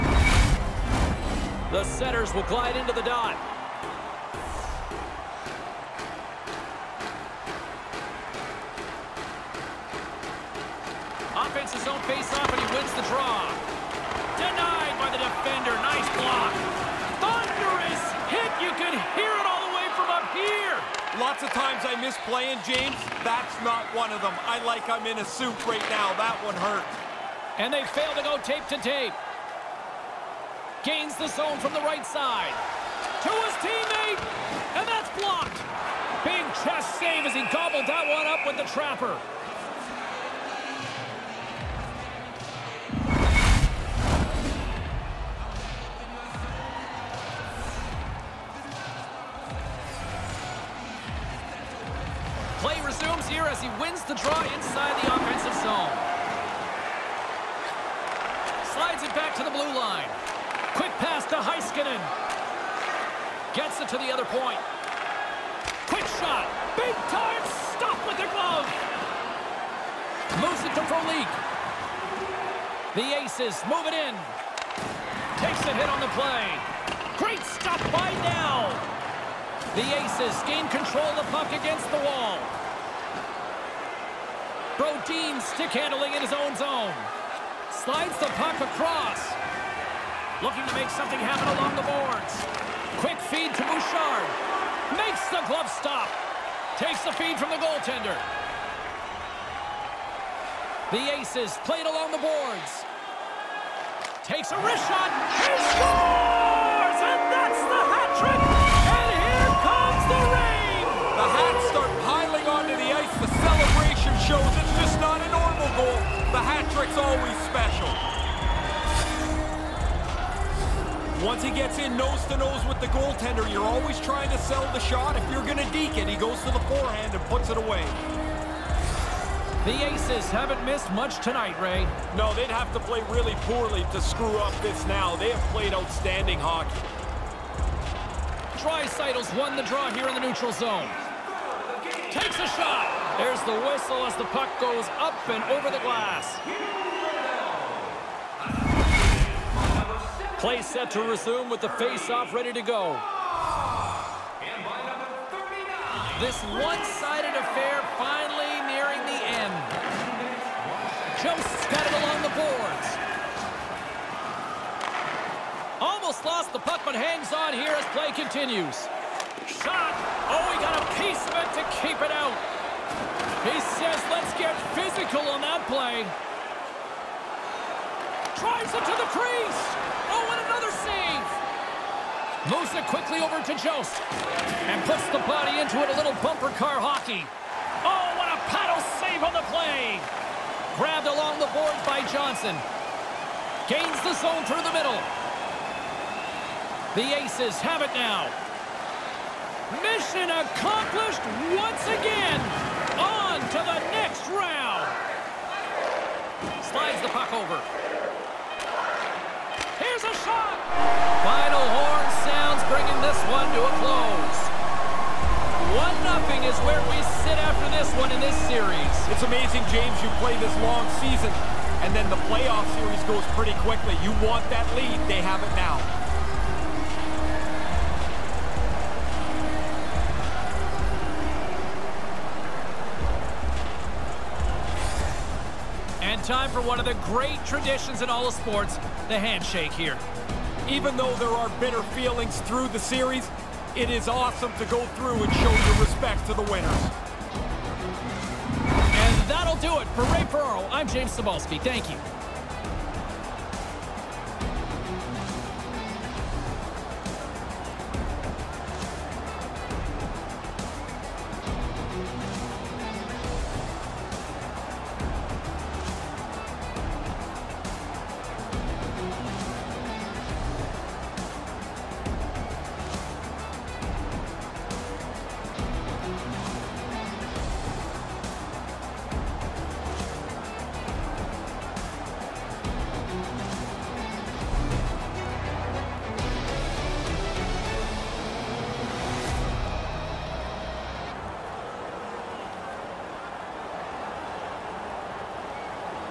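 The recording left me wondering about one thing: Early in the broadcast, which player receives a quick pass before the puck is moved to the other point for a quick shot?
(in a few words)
Heiskanen.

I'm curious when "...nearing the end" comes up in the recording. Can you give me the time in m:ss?
2:38.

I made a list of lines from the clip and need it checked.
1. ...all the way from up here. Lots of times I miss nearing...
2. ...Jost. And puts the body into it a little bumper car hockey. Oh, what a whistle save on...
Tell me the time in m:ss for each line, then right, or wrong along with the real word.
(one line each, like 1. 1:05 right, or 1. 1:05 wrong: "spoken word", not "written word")
1. 0:19 wrong: "playing", not "nearing"
2. 3:03 wrong: "paddle", not "whistle".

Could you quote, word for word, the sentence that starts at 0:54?
the try inside the offensive zone.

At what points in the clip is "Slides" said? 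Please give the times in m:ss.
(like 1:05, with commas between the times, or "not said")
0:58, 1:27.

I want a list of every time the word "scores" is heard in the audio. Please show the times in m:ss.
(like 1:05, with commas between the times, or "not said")
1:45.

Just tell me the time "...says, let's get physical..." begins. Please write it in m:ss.
2:53.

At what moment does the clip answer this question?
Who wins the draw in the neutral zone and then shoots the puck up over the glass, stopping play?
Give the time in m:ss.
2:18.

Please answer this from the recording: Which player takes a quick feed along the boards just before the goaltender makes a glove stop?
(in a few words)
Bouchard.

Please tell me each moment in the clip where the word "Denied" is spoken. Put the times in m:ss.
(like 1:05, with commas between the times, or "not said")
0:14.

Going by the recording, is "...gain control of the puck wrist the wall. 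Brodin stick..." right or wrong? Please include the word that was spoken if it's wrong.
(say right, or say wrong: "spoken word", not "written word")
wrong: "against", not "wrist".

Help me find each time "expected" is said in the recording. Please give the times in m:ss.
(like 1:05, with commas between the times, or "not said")
not said.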